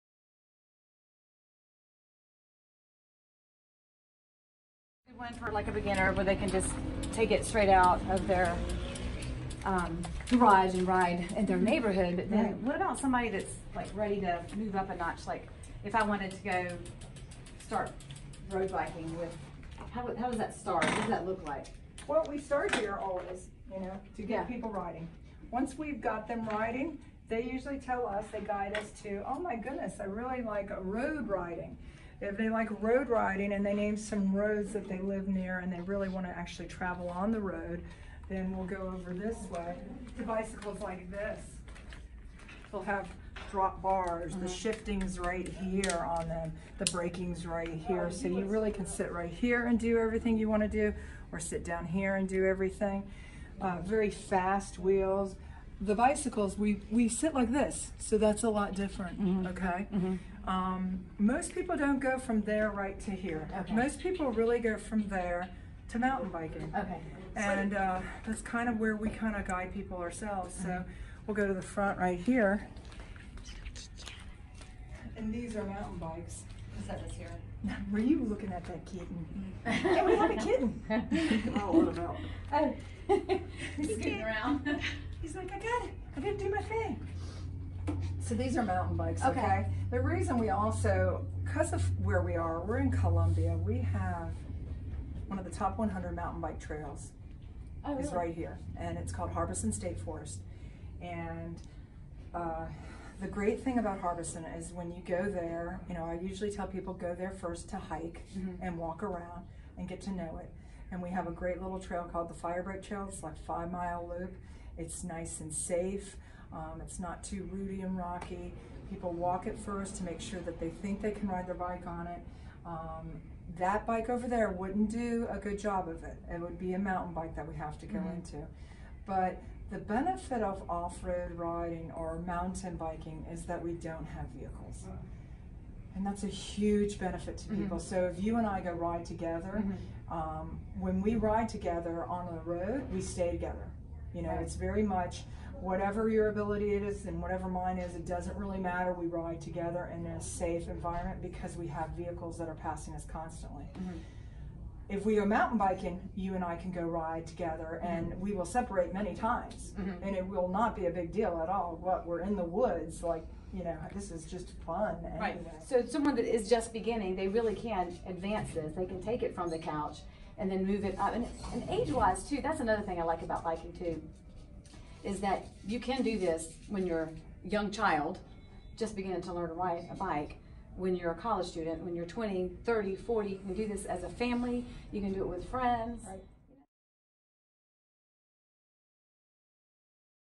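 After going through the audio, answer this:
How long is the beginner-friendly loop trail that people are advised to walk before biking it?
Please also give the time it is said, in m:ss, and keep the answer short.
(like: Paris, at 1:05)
5 miles, at 1:53.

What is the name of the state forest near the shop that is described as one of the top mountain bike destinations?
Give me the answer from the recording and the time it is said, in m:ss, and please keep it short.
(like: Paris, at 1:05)
Harbison State Forest, at 1:39.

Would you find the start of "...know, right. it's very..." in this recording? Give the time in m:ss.
2:24.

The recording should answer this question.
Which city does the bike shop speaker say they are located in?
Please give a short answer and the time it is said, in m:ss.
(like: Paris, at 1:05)
Columbia, at 1:32.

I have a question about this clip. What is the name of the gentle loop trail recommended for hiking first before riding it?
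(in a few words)
Firebreak Trail.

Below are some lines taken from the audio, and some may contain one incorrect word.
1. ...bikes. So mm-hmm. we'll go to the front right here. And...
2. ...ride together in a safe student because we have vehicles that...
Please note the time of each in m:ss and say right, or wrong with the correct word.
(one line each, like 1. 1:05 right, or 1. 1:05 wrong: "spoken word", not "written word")
1. 1:09 wrong: "ourselves", not "bikes"
2. 2:29 wrong: "environment", not "student".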